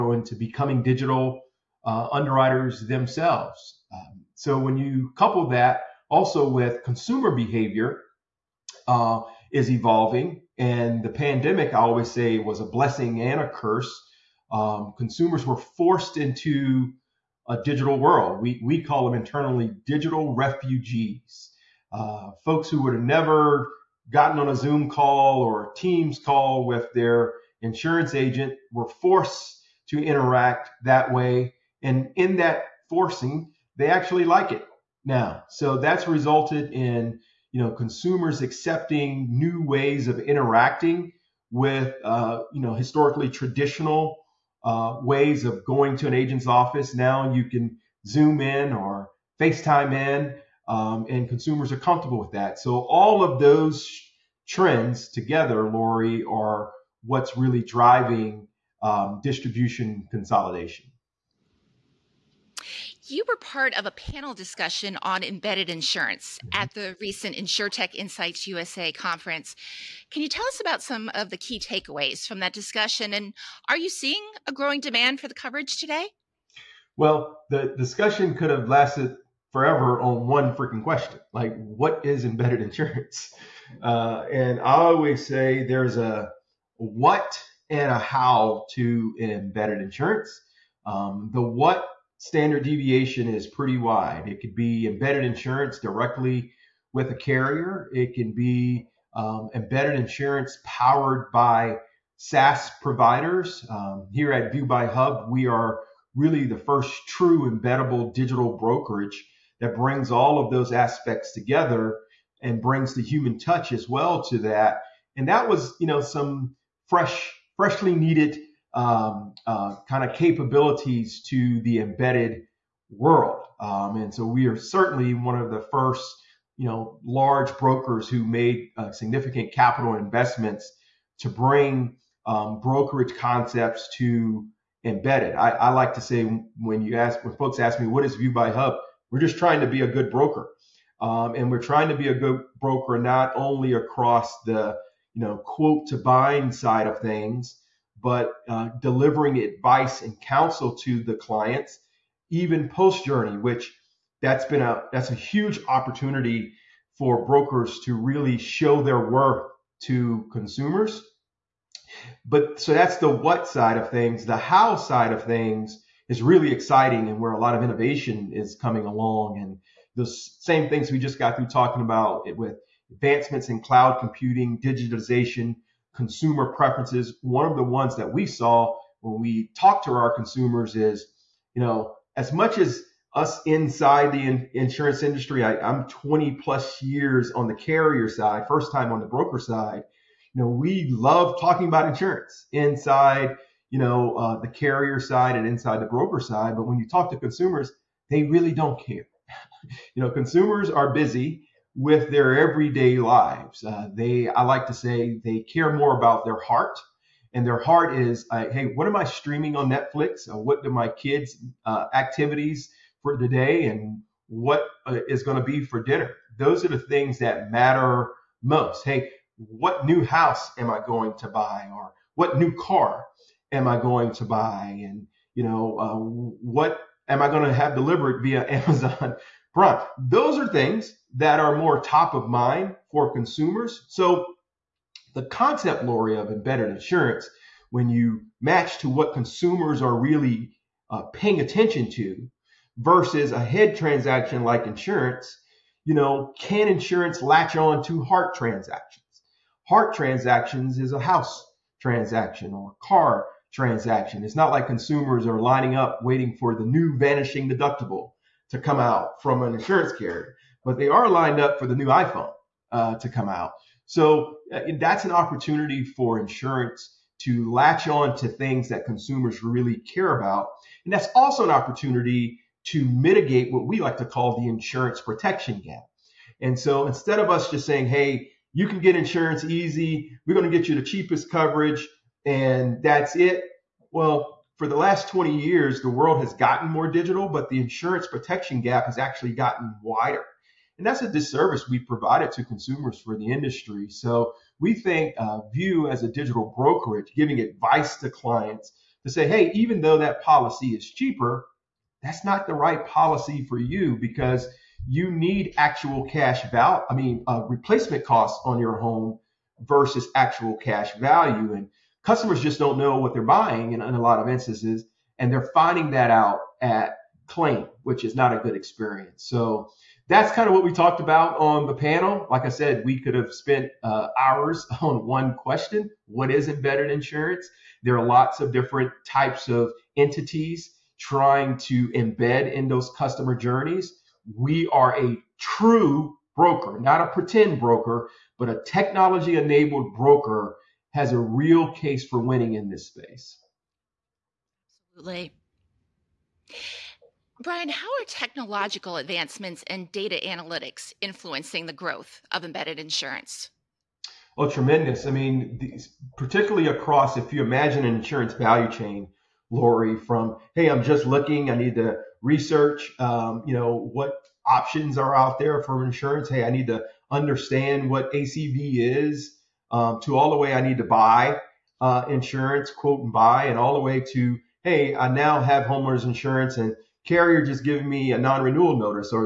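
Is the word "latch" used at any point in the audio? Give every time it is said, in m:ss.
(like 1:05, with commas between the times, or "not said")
4:07, 4:27.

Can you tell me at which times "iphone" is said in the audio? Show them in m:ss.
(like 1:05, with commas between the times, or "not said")
4:21.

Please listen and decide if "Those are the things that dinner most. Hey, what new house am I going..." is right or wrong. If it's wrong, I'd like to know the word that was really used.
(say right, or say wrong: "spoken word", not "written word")
wrong: "matter", not "dinner".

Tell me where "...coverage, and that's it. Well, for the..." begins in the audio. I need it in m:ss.
4:41.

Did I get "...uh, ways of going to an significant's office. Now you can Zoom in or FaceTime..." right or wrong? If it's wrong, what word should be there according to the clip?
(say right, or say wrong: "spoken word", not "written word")
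wrong: "agent", not "significant".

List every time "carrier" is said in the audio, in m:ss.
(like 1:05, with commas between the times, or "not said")
1:37, 3:07, 3:14, 4:19, 6:17.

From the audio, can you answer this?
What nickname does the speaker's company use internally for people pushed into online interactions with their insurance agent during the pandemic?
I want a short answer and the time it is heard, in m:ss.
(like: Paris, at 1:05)
digital refugees, at 0:19.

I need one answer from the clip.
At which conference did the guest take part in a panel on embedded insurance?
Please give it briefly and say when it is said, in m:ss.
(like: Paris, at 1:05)
InsurTech Insights USA, at 1:07.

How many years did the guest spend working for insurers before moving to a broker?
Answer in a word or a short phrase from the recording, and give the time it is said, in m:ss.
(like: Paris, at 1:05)
20 plus, at 3:05.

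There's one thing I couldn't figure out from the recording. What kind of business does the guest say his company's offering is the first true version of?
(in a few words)
embeddable digital brokerage.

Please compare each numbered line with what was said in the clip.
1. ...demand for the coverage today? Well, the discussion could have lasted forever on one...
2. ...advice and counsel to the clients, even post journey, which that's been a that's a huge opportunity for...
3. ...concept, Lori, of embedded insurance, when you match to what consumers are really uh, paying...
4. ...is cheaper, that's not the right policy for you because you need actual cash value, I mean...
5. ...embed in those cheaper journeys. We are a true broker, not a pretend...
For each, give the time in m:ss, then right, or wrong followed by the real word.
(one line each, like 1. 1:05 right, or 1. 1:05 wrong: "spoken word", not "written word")
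1. 1:14 right
2. 2:29 right
3. 3:55 right
4. 5:00 right
5. 5:31 wrong: "customer", not "cheaper".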